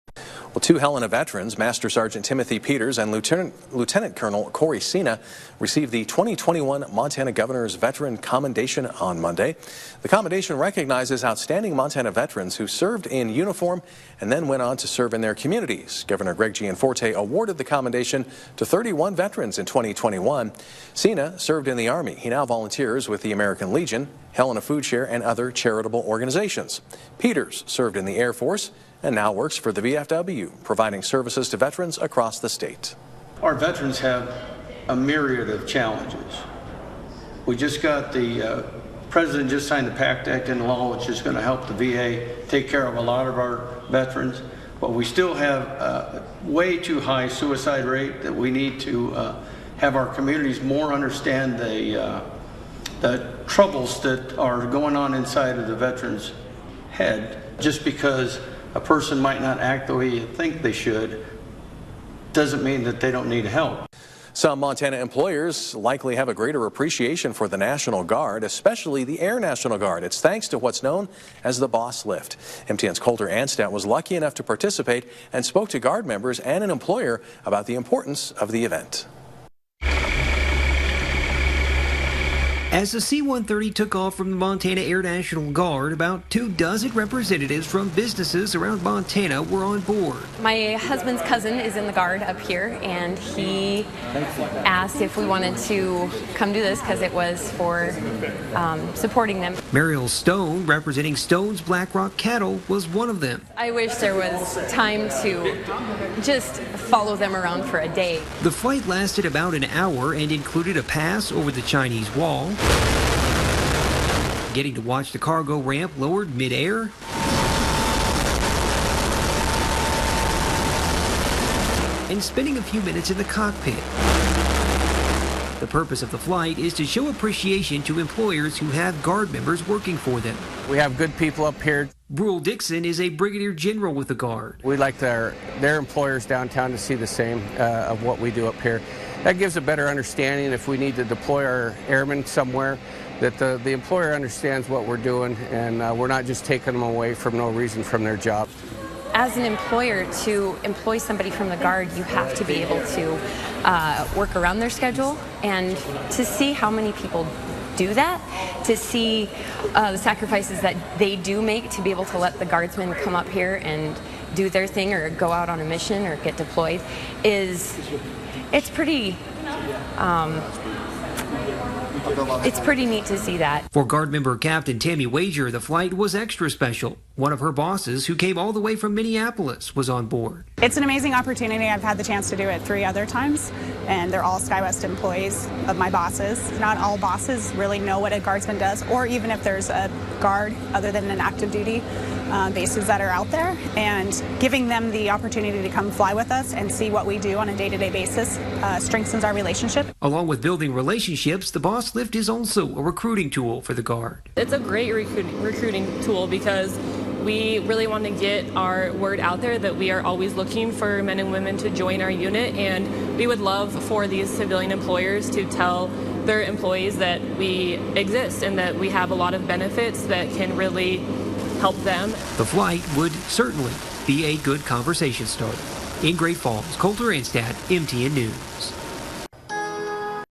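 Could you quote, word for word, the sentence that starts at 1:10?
It's thanks to what's known as the Boss Lift.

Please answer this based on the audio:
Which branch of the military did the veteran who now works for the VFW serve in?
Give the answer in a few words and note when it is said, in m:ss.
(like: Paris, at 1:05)
Air Force, at 0:28.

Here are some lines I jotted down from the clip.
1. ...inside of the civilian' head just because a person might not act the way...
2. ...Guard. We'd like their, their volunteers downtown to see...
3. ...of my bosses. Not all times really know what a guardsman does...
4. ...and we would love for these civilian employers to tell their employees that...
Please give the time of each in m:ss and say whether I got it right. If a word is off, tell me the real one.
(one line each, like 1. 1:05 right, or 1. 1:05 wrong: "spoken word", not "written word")
1. 0:55 wrong: "veterans", not "civilian"
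2. 2:14 wrong: "employers", not "volunteers"
3. 3:05 wrong: "bosses", not "times"
4. 3:32 right.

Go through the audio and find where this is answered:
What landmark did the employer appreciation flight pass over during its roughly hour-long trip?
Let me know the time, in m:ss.
1:51.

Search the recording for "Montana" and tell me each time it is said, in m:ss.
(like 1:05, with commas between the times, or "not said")
0:06, 0:11, 1:04, 1:24, 1:28.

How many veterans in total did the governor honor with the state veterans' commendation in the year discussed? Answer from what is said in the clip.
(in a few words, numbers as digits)
31.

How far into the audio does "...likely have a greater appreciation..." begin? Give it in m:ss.
1:05.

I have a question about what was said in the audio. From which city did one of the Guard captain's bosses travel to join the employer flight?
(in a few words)
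Minneapolis.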